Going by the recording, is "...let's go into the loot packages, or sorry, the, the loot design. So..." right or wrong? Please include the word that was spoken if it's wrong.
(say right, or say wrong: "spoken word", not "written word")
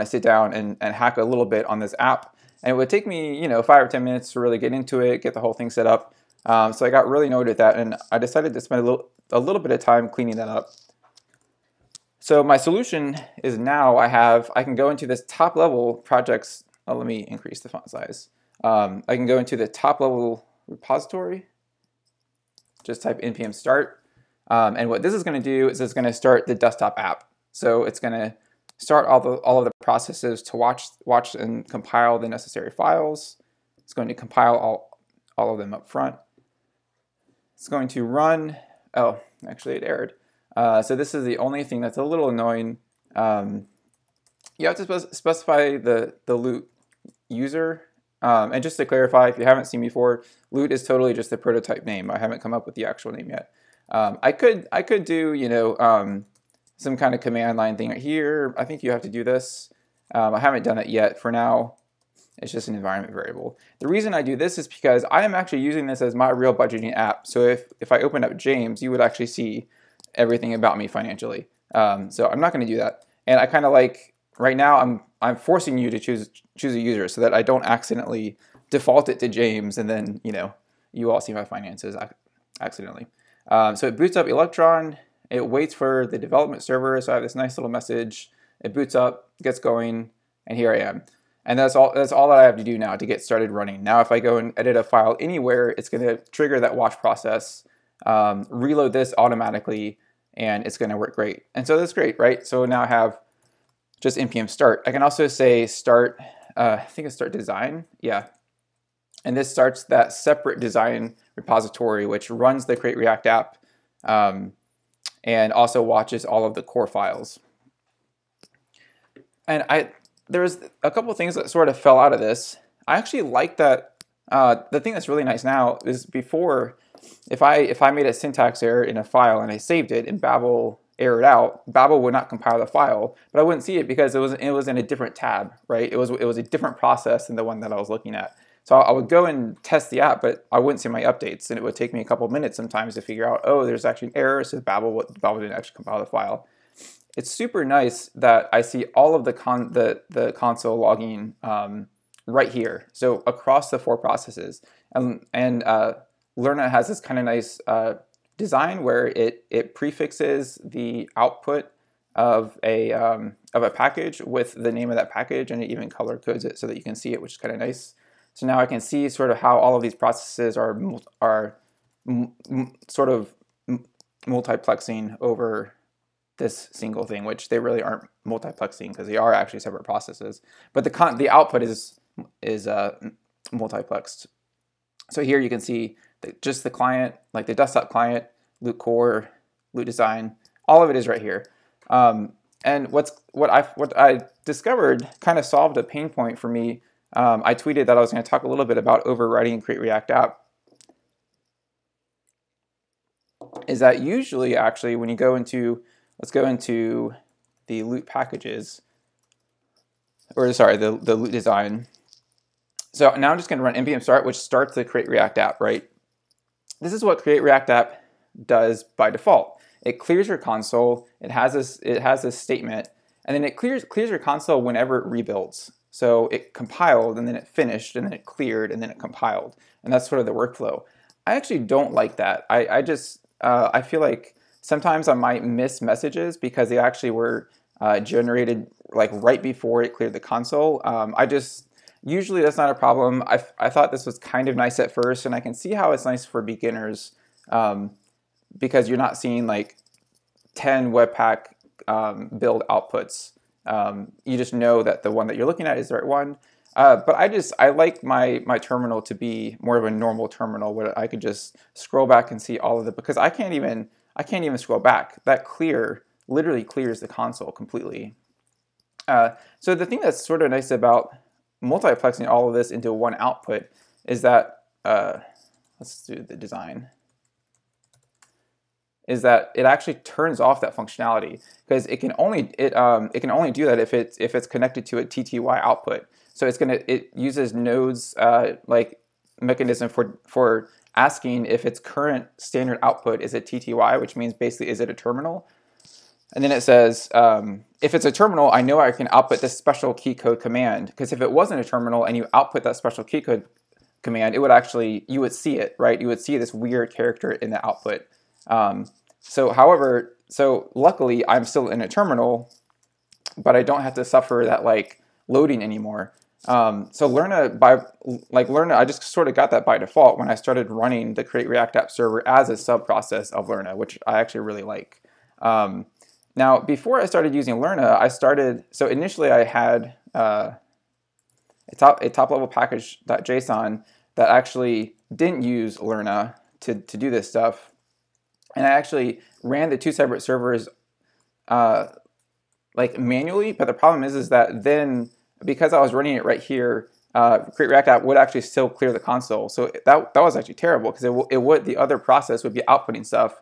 right.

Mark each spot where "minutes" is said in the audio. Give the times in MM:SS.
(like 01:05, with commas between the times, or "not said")
00:04, 02:22.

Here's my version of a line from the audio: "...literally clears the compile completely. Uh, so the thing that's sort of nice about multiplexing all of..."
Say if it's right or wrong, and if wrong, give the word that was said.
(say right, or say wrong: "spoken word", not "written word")
wrong: "console", not "compile".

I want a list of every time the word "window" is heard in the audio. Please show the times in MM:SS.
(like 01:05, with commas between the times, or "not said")
not said.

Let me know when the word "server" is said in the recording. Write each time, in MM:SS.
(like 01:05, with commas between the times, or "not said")
01:26, 05:21, 05:40.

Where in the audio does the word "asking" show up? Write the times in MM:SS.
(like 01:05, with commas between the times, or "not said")
04:50.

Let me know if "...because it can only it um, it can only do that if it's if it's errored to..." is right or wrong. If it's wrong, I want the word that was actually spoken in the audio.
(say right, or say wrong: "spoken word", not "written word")
wrong: "connected", not "errored".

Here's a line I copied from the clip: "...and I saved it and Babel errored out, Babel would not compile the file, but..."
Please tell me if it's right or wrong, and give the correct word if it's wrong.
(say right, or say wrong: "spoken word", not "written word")
right.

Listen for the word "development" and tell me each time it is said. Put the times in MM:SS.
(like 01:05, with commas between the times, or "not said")
01:26.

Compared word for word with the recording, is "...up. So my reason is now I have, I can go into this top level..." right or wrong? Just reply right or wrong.
wrong.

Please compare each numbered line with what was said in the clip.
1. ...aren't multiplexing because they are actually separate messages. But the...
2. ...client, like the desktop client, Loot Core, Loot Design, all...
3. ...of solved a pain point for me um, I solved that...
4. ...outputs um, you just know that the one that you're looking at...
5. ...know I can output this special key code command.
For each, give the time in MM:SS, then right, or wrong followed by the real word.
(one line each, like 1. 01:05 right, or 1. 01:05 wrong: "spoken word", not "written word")
1. 02:57 wrong: "processes", not "messages"
2. 03:06 right
3. 03:15 wrong: "tweeted", not "solved"
4. 04:12 right
5. 04:58 right.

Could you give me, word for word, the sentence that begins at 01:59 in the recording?
And I there's a couple things that sort of fell out of this.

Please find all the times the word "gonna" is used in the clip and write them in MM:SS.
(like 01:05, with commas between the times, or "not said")
01:35, 01:40, 04:46.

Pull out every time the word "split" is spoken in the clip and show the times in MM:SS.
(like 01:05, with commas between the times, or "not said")
not said.